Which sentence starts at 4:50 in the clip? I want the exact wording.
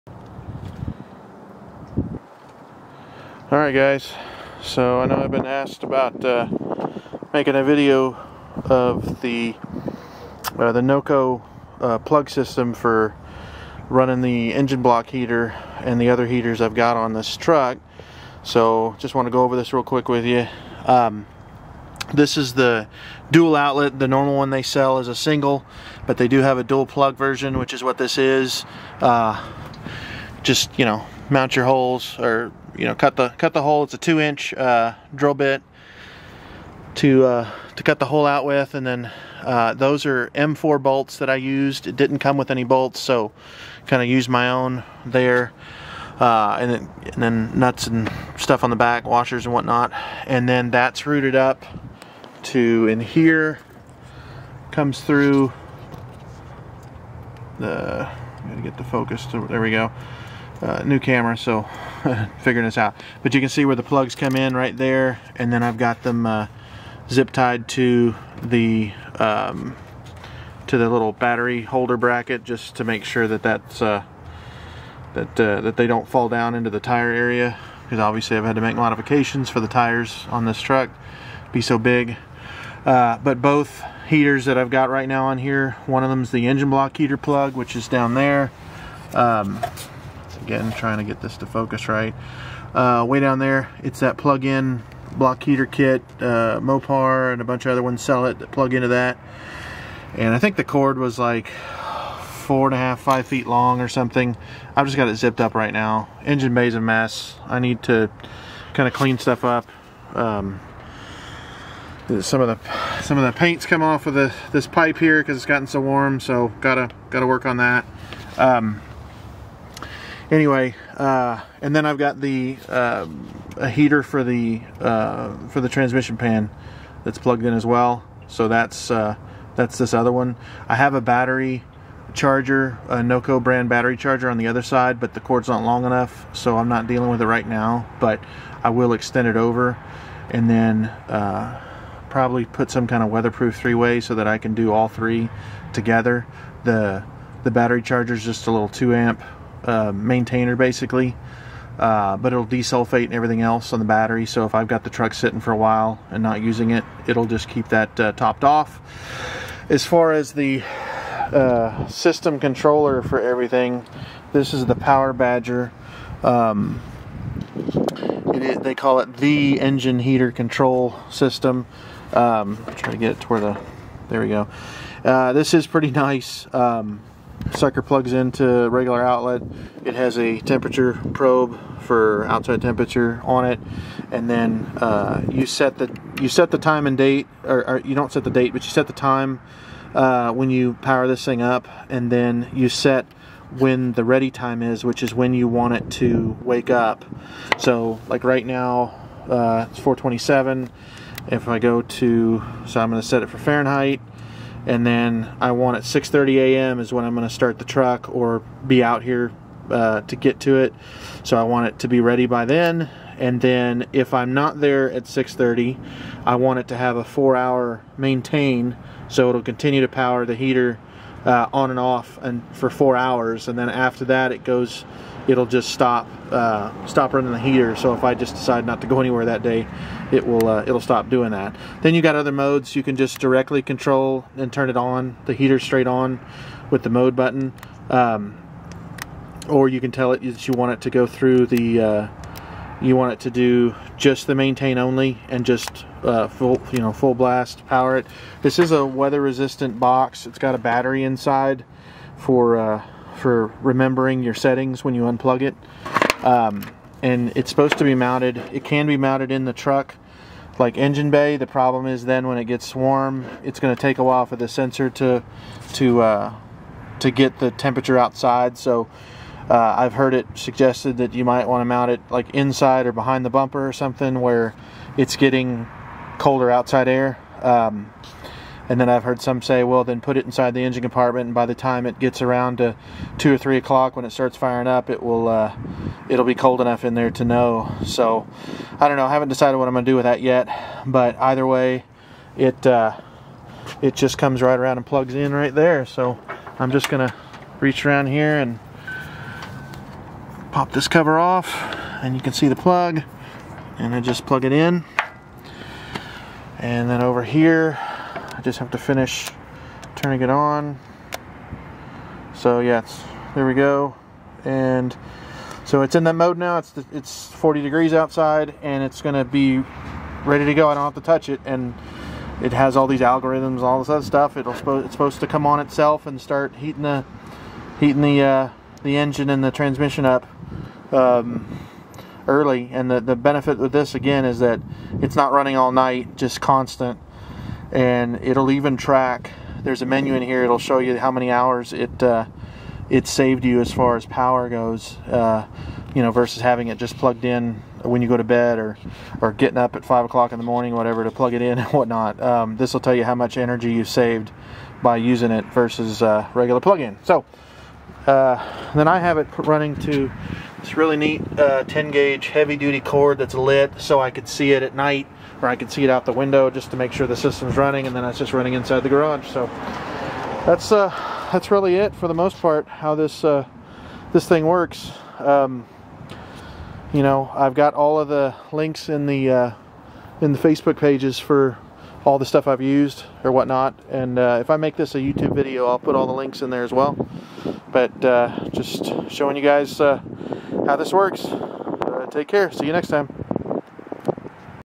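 But either way, it uh, it just comes right around and plugs in right there.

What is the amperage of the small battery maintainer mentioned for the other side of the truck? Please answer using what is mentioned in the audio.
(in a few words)
2 amp.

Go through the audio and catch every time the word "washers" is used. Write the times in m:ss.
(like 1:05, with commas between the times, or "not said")
0:49.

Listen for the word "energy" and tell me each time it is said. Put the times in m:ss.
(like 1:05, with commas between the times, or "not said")
5:53.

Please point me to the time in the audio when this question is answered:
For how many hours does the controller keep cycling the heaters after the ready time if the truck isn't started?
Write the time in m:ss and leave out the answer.
3:37.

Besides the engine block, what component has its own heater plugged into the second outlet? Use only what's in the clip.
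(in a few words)
transmission pan.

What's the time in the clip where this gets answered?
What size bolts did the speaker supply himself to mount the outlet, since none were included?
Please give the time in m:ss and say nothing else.
0:40.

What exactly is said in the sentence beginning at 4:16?
Um, and it's supposed to be mounted, it can be mounted in the truck like engine bay.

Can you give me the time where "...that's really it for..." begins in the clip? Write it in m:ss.
6:11.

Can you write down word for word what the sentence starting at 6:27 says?
But uh, just showing you guys uh, how this works.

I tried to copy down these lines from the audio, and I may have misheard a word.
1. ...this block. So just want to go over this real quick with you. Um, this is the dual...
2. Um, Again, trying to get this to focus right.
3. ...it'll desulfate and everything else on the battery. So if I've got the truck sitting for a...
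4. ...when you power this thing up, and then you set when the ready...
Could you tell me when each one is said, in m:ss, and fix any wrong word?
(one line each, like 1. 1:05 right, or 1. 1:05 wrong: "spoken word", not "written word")
1. 0:17 wrong: "truck", not "block"
2. 1:29 right
3. 2:32 right
4. 3:10 right.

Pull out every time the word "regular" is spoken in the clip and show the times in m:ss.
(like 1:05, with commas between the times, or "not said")
2:58, 5:56.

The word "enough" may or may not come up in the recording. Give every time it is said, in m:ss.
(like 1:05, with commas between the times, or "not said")
2:15, 4:46.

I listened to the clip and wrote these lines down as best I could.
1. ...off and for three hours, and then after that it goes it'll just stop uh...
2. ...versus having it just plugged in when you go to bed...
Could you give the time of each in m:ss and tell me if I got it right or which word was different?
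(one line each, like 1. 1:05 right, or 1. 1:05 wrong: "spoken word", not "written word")
1. 3:41 wrong: "four", not "three"
2. 5:46 right.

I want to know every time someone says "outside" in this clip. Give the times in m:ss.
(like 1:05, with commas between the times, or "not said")
3:02, 4:27, 4:36, 5:17.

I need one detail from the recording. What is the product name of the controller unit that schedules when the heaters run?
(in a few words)
Power Badger.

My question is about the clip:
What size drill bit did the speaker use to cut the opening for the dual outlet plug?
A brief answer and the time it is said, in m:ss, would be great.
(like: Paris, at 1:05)
2 inch, at 0:33.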